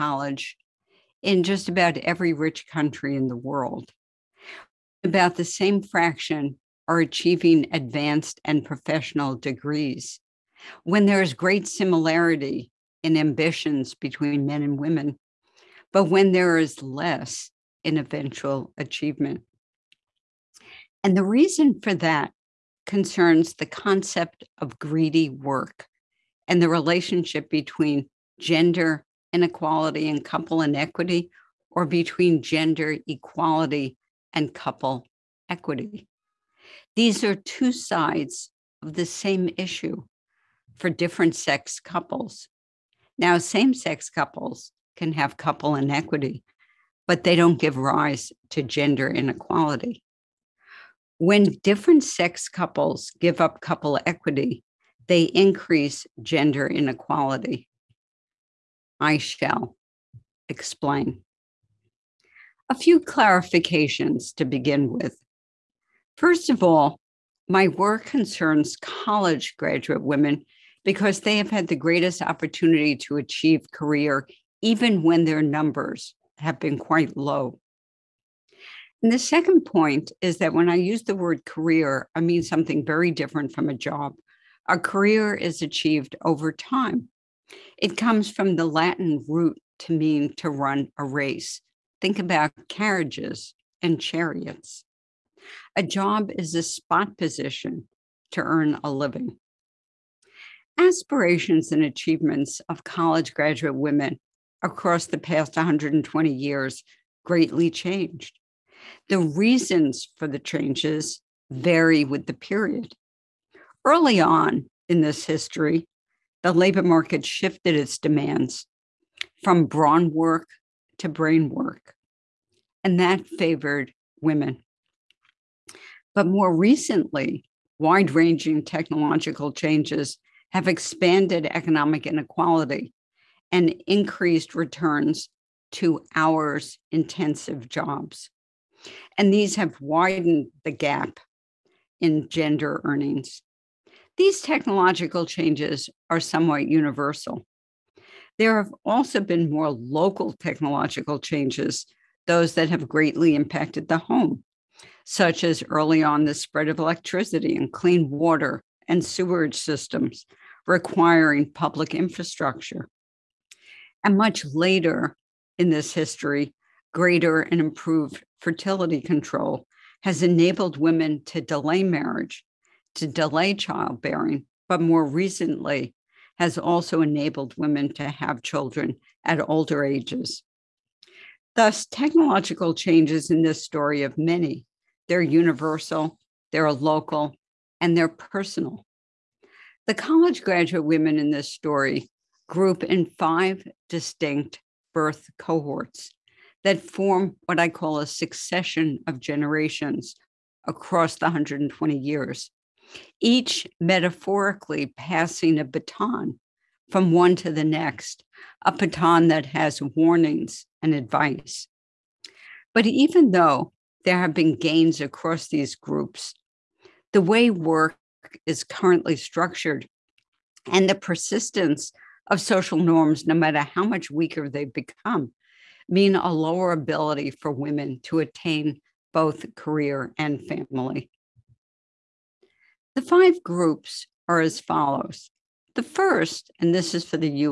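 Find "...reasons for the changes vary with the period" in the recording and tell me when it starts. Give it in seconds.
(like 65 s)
109 s.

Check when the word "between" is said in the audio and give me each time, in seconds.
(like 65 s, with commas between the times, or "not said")
13 s, 27 s, 31 s.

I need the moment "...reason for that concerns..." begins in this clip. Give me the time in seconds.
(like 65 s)
21 s.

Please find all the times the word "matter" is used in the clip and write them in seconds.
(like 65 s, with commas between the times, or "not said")
223 s.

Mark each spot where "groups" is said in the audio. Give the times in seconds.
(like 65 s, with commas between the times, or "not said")
192 s, 215 s, 233 s.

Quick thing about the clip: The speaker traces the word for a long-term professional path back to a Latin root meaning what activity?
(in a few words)
to run a race.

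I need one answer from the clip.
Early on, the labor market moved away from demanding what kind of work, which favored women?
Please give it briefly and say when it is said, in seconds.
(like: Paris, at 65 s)
brawn work, at 119 s.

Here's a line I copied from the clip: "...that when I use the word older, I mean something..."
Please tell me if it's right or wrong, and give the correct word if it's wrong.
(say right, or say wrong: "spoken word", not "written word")
wrong: "career", not "older".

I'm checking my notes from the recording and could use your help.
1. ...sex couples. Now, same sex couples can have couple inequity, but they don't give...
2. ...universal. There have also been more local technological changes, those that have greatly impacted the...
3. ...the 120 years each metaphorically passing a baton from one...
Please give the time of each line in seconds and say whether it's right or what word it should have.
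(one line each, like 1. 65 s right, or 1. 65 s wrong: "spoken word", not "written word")
1. 41 s right
2. 146 s right
3. 201 s right.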